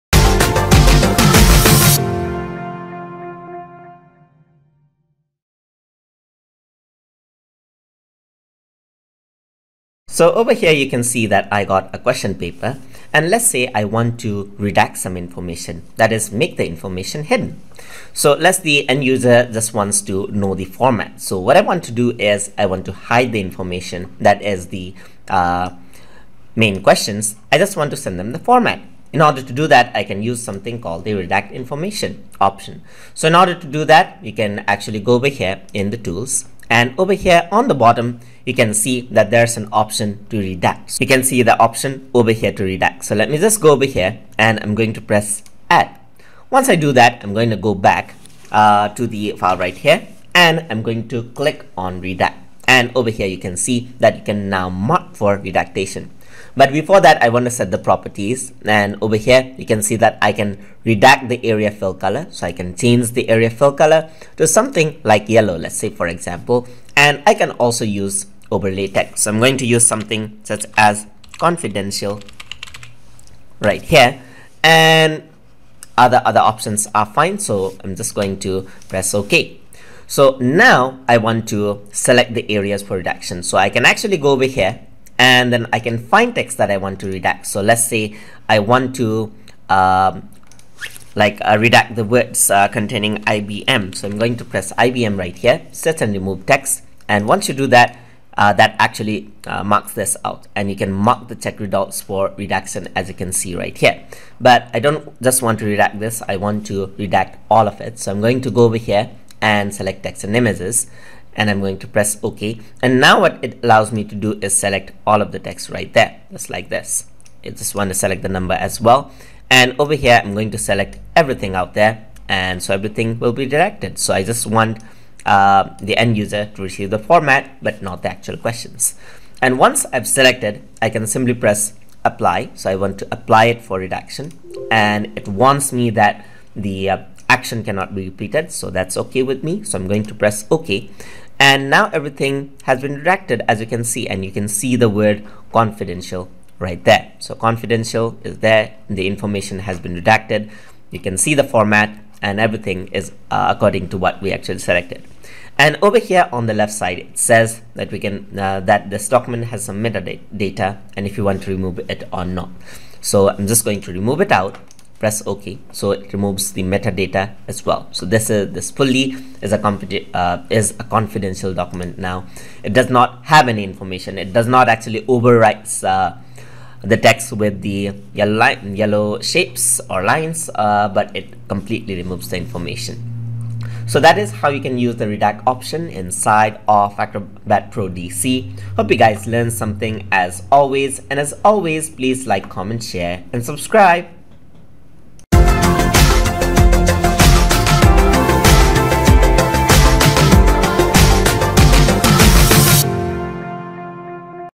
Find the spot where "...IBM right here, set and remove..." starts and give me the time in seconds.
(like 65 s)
94 s.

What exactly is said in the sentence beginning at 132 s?
So I want to apply it for redaction.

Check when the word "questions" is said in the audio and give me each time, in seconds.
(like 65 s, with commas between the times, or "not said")
11 s, 26 s, 128 s.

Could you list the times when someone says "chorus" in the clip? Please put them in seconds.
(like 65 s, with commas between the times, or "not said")
not said.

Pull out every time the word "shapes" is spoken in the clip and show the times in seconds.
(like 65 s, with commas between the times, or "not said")
179 s.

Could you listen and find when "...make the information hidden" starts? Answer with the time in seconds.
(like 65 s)
16 s.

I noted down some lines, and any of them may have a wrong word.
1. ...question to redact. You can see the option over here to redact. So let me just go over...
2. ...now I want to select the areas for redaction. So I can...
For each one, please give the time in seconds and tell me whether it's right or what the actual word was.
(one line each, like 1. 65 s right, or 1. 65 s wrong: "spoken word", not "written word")
1. 39 s wrong: "option", not "question"
2. 80 s right.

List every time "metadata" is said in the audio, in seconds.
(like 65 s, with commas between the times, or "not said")
159 s, 166 s.